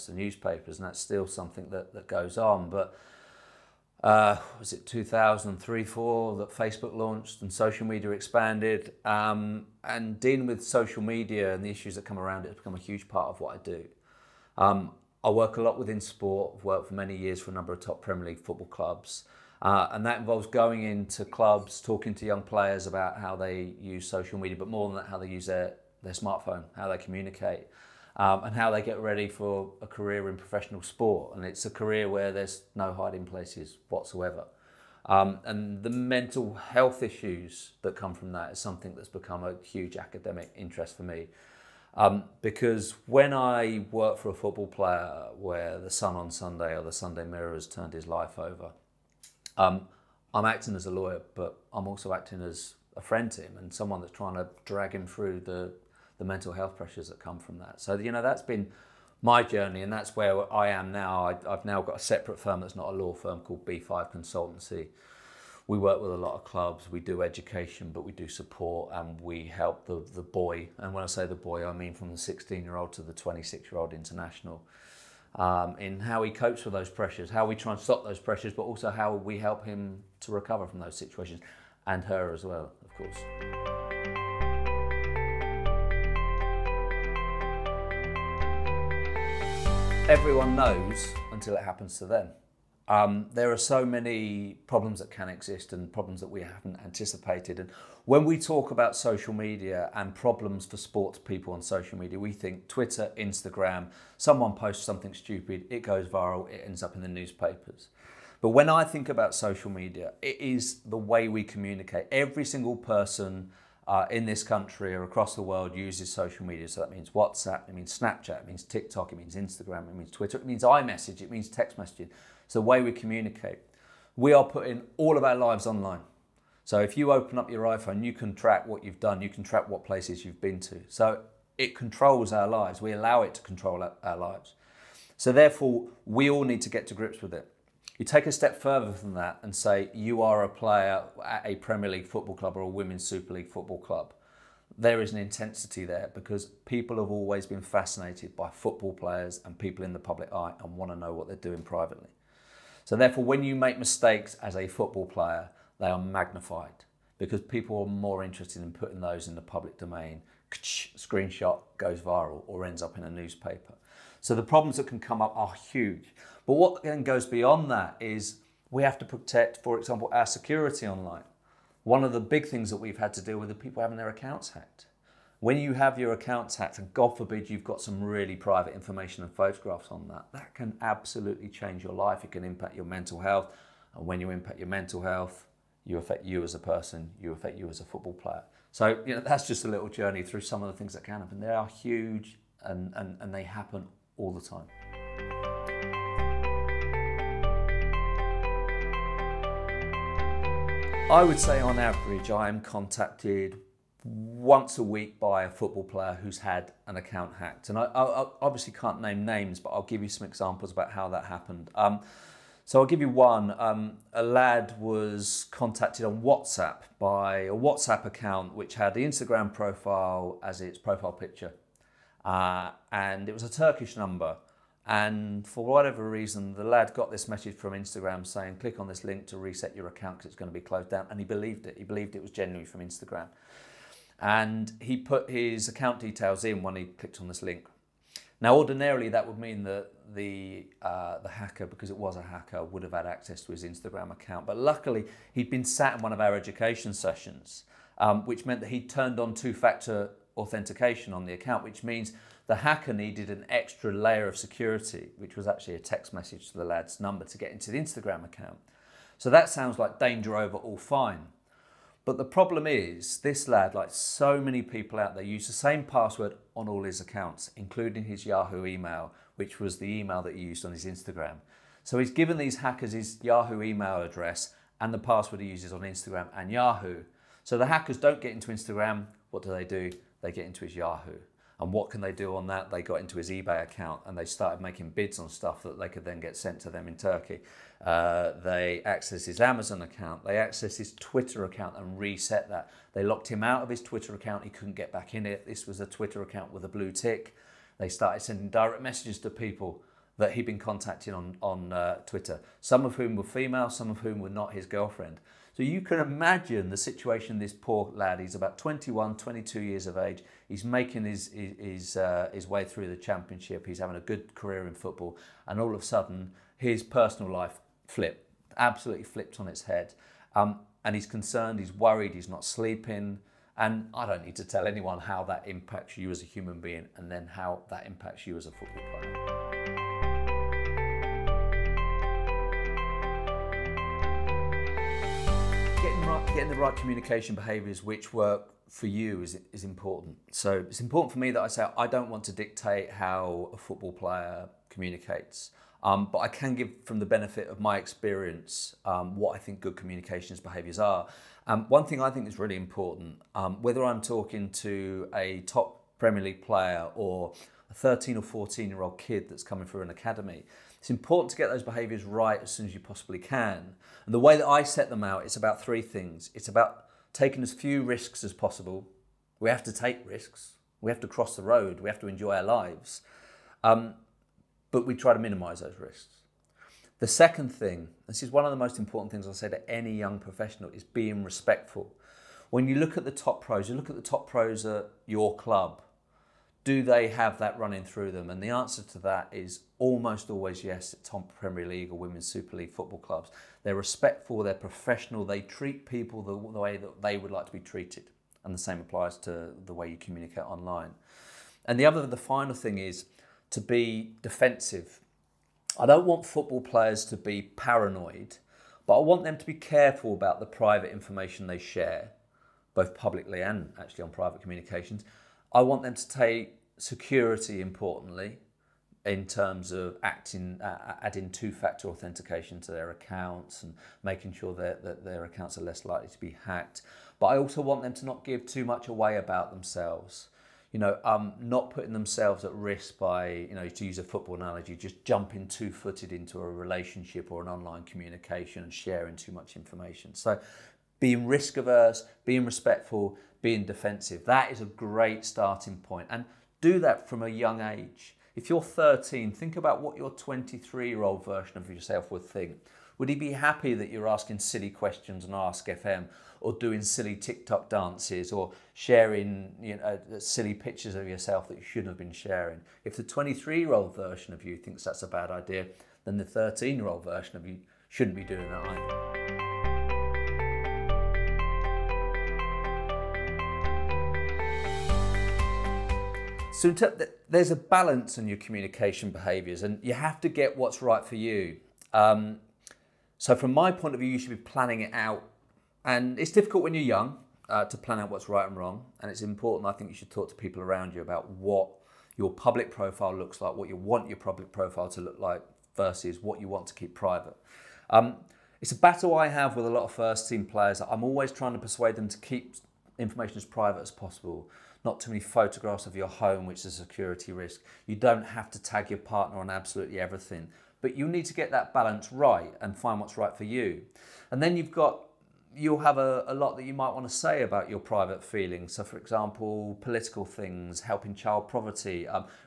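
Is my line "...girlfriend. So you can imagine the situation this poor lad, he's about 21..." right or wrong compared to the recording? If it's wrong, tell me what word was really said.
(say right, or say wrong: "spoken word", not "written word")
right.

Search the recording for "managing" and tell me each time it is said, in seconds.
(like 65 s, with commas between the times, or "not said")
not said.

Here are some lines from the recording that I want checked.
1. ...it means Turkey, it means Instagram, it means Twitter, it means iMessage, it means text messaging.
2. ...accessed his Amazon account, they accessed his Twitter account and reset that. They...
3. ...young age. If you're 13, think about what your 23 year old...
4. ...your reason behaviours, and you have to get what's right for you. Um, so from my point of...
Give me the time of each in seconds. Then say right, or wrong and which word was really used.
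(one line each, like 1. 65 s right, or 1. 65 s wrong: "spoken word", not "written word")
1. 118 s wrong: "TikTok", not "Turkey"
2. 288 s right
3. 447 s right
4. 478 s wrong: "communication", not "reason".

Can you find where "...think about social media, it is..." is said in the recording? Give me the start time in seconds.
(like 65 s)
108 s.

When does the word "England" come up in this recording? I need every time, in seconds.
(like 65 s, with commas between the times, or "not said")
not said.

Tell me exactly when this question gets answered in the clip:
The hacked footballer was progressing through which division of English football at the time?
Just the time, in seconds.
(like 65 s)
312 s.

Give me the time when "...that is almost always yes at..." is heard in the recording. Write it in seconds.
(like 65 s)
388 s.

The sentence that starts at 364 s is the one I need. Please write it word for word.
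And the way that I set them out, it's about three things.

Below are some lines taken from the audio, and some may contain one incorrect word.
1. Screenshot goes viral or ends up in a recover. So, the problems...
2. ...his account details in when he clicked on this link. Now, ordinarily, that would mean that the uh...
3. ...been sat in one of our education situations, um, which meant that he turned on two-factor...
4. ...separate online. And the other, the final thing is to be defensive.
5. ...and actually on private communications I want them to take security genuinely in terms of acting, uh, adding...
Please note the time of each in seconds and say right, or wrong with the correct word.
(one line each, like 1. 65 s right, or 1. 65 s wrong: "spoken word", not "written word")
1. 160 s wrong: "newspaper", not "recover"
2. 235 s right
3. 245 s wrong: "sessions", not "situations"
4. 399 s wrong: "communicate", not "separate"
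5. 413 s wrong: "importantly", not "genuinely".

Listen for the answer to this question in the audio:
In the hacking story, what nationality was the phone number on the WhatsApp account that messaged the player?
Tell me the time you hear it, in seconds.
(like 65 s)
223 s.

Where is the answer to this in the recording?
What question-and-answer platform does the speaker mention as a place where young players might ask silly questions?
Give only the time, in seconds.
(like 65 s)
455 s.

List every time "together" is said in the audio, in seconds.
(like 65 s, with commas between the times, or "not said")
not said.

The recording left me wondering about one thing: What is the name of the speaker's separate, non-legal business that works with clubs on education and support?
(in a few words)
B5 Consultancy.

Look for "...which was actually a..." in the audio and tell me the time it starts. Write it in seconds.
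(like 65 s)
255 s.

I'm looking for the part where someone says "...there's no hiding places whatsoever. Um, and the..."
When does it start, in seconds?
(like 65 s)
32 s.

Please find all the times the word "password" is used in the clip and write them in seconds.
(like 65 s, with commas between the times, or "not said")
265 s, 274 s.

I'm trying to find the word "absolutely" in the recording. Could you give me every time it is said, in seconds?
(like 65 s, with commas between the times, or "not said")
180 s, 318 s, 509 s.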